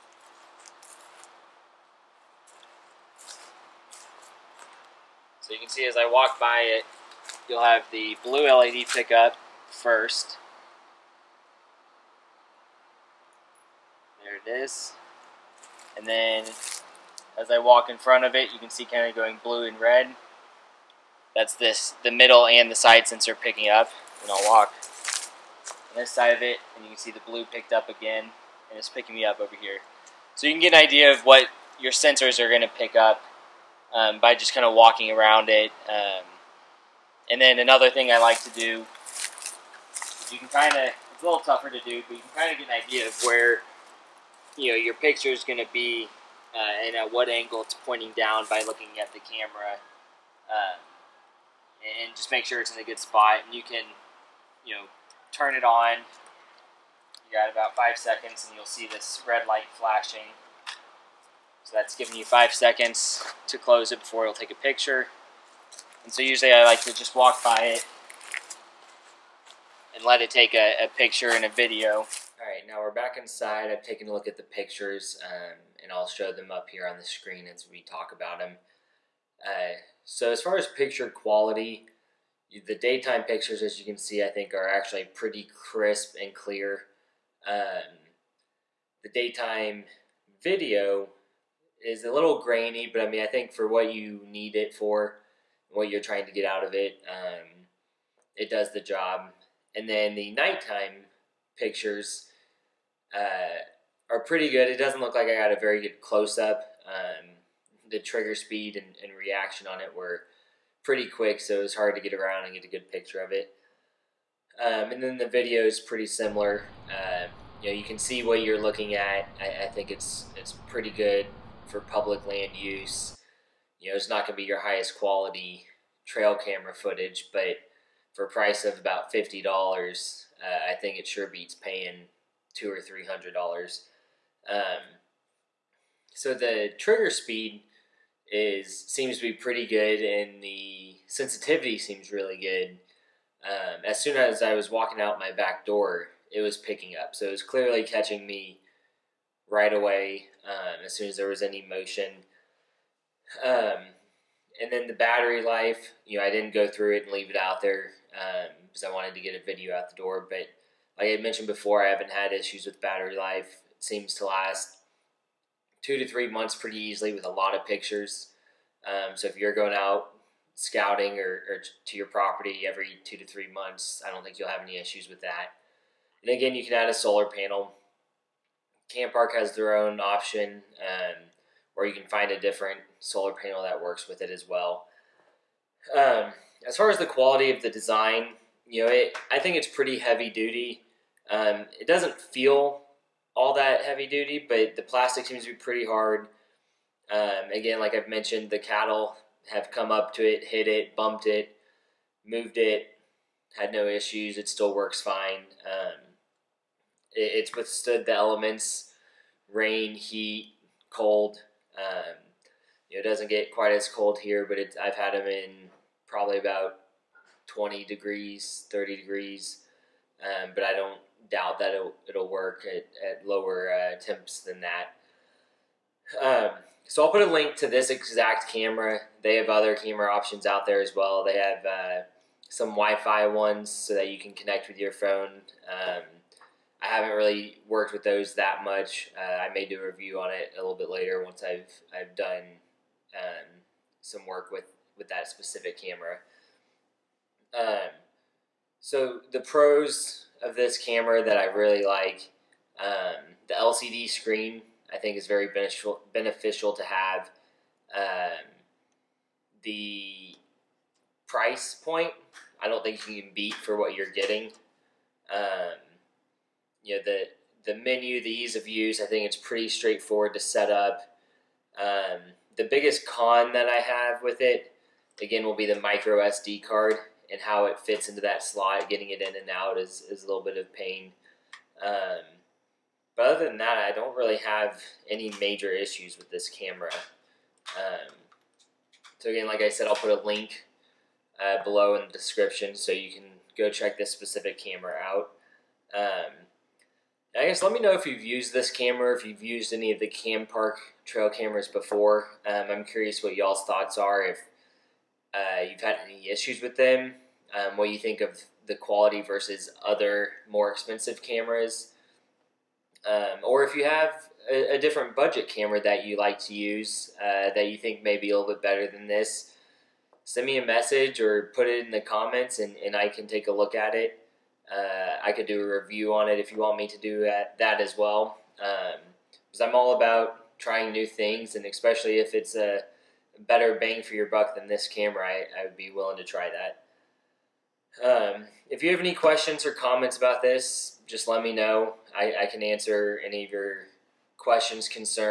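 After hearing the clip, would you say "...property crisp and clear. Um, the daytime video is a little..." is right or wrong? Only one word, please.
wrong.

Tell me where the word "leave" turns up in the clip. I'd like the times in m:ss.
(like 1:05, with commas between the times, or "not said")
2:37.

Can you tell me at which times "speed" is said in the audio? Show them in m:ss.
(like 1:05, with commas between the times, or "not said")
1:48, 2:17.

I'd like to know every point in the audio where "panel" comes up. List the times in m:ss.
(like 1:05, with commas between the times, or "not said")
2:57, 3:03.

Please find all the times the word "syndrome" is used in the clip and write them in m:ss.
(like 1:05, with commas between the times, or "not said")
not said.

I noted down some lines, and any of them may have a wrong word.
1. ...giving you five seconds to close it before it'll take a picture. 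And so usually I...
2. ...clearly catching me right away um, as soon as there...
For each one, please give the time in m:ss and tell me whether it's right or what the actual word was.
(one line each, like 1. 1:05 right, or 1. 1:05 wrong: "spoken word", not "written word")
1. 1:01 right
2. 2:27 right.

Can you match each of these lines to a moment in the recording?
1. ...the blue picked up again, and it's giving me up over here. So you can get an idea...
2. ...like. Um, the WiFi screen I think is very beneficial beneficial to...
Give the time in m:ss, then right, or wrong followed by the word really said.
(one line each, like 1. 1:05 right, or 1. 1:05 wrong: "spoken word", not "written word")
1. 0:27 wrong: "picking", not "giving"
2. 4:11 wrong: "LCD", not "WiFi".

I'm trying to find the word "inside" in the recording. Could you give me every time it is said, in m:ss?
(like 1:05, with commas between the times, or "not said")
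1:13.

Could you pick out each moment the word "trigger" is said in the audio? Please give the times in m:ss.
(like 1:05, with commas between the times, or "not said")
1:47, 2:16.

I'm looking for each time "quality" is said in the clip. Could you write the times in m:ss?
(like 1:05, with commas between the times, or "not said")
1:21, 2:04, 3:07, 5:08.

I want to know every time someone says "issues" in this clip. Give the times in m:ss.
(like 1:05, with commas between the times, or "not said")
2:42, 2:54, 3:23, 4:45, 5:06.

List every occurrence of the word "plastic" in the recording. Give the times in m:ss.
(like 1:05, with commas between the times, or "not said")
3:14.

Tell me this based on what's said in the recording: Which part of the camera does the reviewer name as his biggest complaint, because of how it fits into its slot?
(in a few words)
micro SD card.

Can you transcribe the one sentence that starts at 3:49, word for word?
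They have other camera options out there as well.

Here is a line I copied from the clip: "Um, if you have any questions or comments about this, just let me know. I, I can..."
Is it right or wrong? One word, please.
right.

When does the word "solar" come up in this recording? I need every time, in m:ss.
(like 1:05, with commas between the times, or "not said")
2:56, 3:02.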